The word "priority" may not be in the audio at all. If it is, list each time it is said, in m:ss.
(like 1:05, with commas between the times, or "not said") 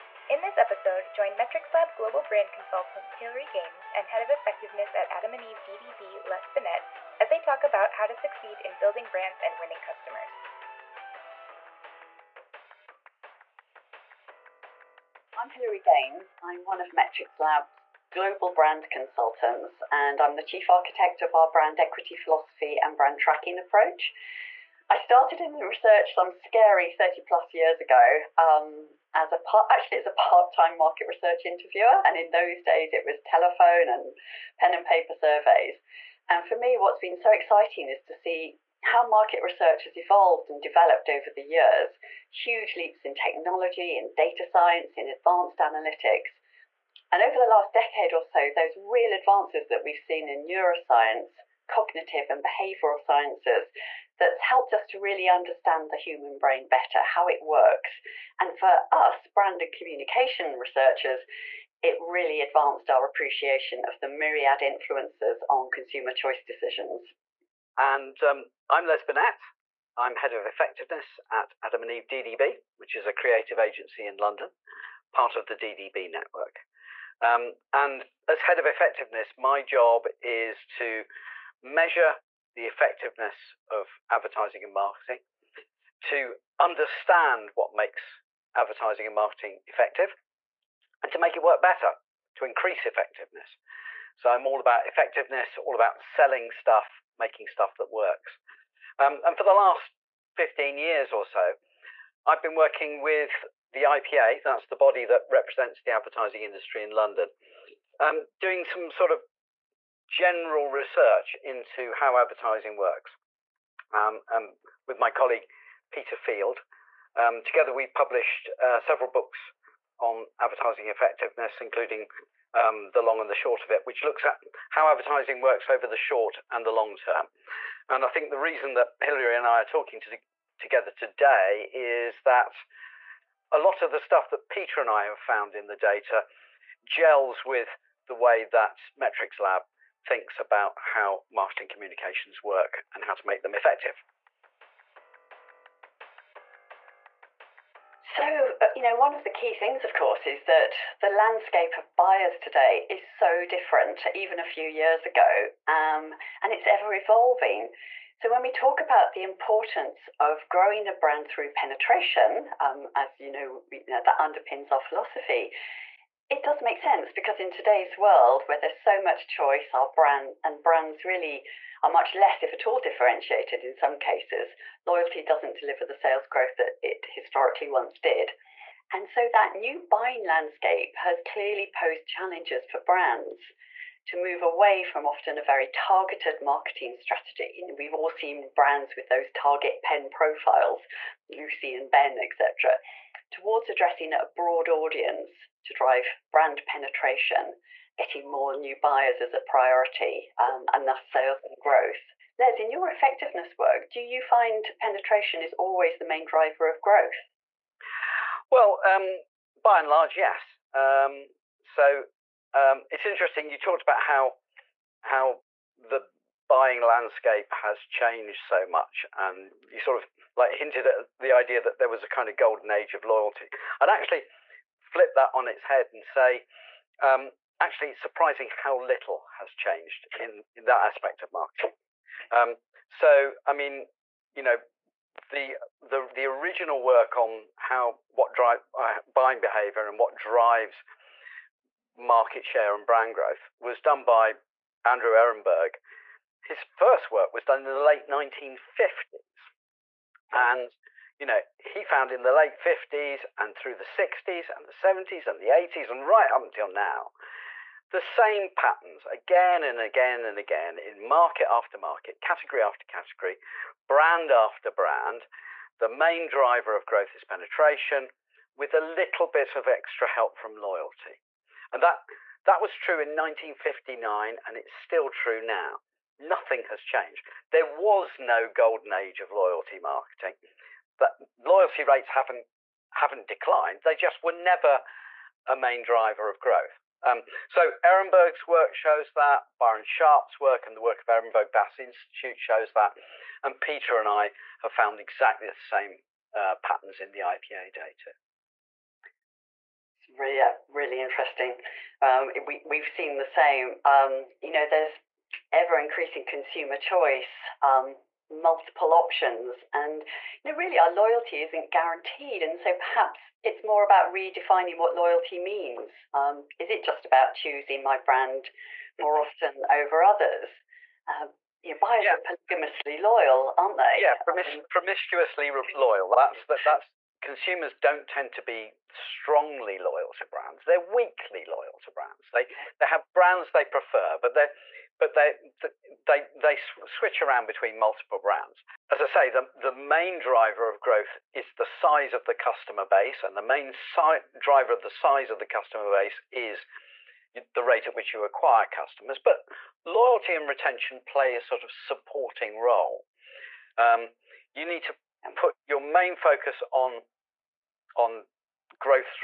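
3:19.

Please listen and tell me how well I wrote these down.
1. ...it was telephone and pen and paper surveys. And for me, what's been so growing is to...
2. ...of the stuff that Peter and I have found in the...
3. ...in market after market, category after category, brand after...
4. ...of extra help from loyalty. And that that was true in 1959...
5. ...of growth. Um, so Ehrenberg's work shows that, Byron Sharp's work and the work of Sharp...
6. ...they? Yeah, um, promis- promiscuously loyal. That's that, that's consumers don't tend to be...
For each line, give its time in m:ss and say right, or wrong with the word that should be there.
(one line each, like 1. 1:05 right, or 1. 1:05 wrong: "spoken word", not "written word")
1. 0:32 wrong: "exciting", not "growing"
2. 2:13 right
3. 4:20 right
4. 4:29 right
5. 4:46 wrong: "Ehrenberg", not "Sharp"
6. 5:23 right.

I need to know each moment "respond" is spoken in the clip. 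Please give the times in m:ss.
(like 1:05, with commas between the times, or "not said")
not said.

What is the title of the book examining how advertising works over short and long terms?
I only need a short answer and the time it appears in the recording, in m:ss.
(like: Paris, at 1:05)
The Long and the Short of It, at 2:02.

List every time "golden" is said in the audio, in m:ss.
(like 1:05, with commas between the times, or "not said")
3:42, 4:38.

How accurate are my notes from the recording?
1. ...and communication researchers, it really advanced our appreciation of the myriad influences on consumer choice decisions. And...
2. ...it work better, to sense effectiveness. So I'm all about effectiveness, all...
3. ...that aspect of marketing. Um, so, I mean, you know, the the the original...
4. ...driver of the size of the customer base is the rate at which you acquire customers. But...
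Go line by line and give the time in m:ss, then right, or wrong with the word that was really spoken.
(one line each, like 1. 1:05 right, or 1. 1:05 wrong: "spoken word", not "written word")
1. 0:59 right
2. 1:31 wrong: "increase", not "sense"
3. 3:50 right
4. 5:44 right.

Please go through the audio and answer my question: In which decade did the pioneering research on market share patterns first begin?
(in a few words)
Late 1950s.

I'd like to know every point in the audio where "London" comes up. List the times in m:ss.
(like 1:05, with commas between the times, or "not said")
1:14, 1:46.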